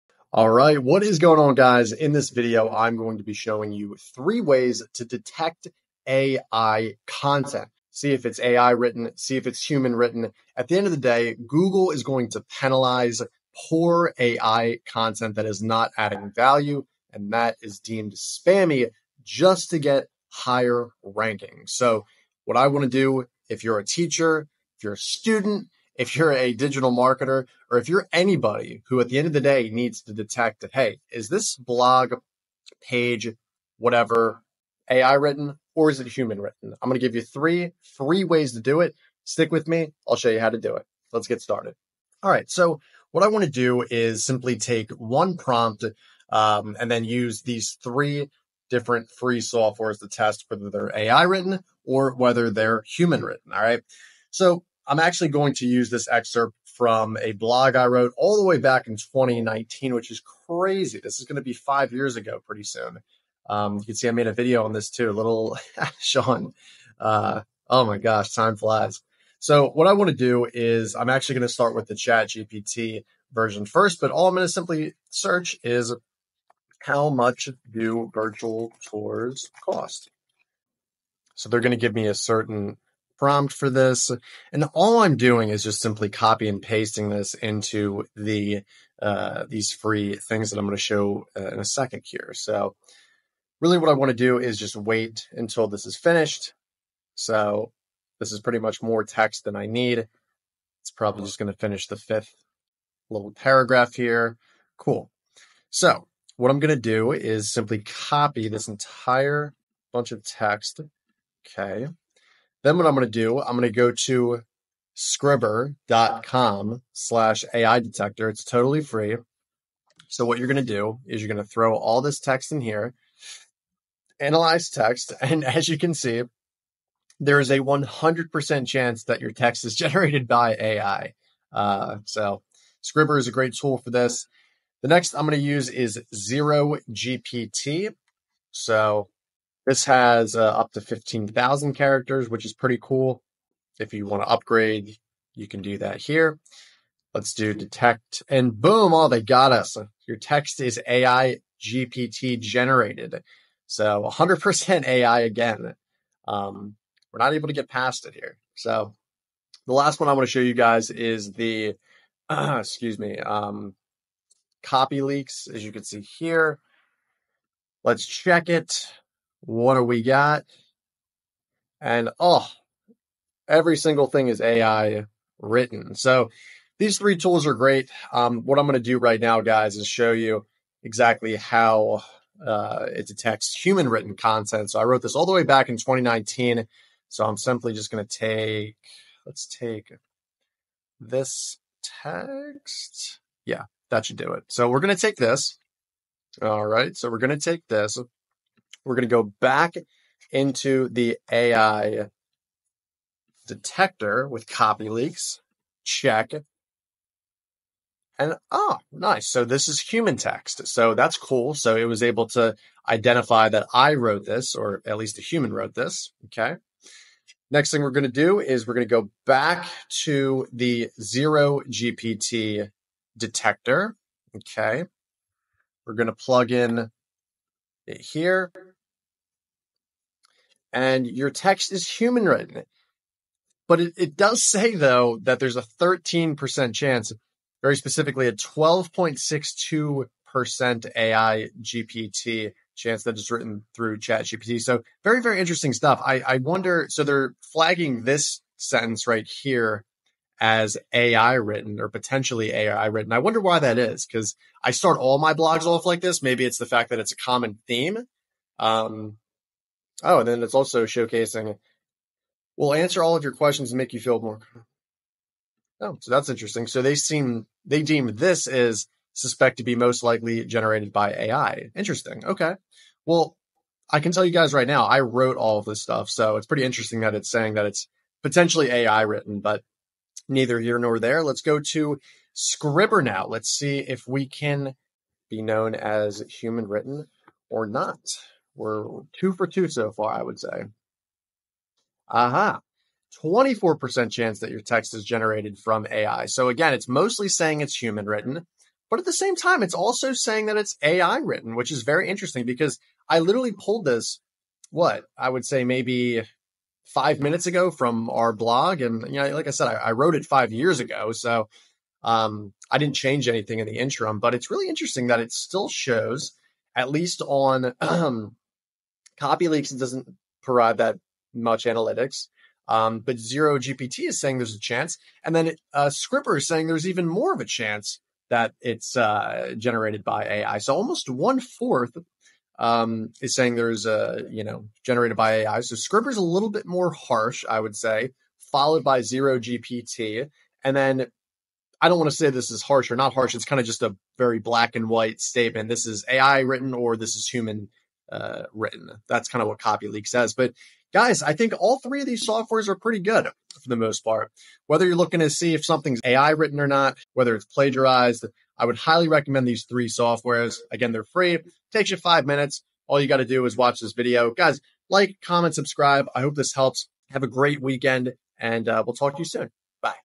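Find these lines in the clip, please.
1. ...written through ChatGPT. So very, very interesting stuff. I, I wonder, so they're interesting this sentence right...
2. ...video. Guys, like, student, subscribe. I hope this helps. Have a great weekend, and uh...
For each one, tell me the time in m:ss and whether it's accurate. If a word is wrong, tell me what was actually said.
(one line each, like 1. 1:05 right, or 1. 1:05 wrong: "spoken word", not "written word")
1. 4:03 wrong: "flagging", not "interesting"
2. 6:03 wrong: "comment", not "student".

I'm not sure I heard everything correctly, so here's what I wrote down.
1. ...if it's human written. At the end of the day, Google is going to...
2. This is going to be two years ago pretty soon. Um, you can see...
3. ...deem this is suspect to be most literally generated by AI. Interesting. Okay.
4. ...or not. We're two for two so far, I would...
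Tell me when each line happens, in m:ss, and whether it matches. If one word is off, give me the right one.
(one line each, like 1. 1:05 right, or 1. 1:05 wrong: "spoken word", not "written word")
1. 0:09 right
2. 1:01 wrong: "five", not "two"
3. 4:27 wrong: "likely", not "literally"
4. 4:47 right.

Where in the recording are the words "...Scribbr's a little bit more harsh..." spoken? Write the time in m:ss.
5:35.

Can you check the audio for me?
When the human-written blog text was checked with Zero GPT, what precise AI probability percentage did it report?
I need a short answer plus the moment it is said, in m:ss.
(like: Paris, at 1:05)
12.62%, at 3:58.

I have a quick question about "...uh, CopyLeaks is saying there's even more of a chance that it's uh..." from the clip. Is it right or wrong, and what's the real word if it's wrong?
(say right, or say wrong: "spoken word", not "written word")
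wrong: "Scripper", not "CopyLeaks".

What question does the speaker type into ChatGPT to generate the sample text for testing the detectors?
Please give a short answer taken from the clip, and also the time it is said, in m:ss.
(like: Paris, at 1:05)
How much do virtual tours cost?, at 1:16.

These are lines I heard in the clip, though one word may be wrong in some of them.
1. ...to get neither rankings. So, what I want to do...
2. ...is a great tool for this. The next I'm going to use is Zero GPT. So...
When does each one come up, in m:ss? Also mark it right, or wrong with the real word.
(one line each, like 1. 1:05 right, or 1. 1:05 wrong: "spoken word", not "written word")
1. 0:19 wrong: "higher", not "neither"
2. 2:13 right.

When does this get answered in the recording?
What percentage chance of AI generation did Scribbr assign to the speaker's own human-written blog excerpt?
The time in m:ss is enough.
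4:53.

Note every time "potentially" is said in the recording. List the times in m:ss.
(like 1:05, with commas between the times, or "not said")
4:11, 4:38.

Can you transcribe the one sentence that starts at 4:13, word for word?
I wonder why that is because I start all my blogs off like this.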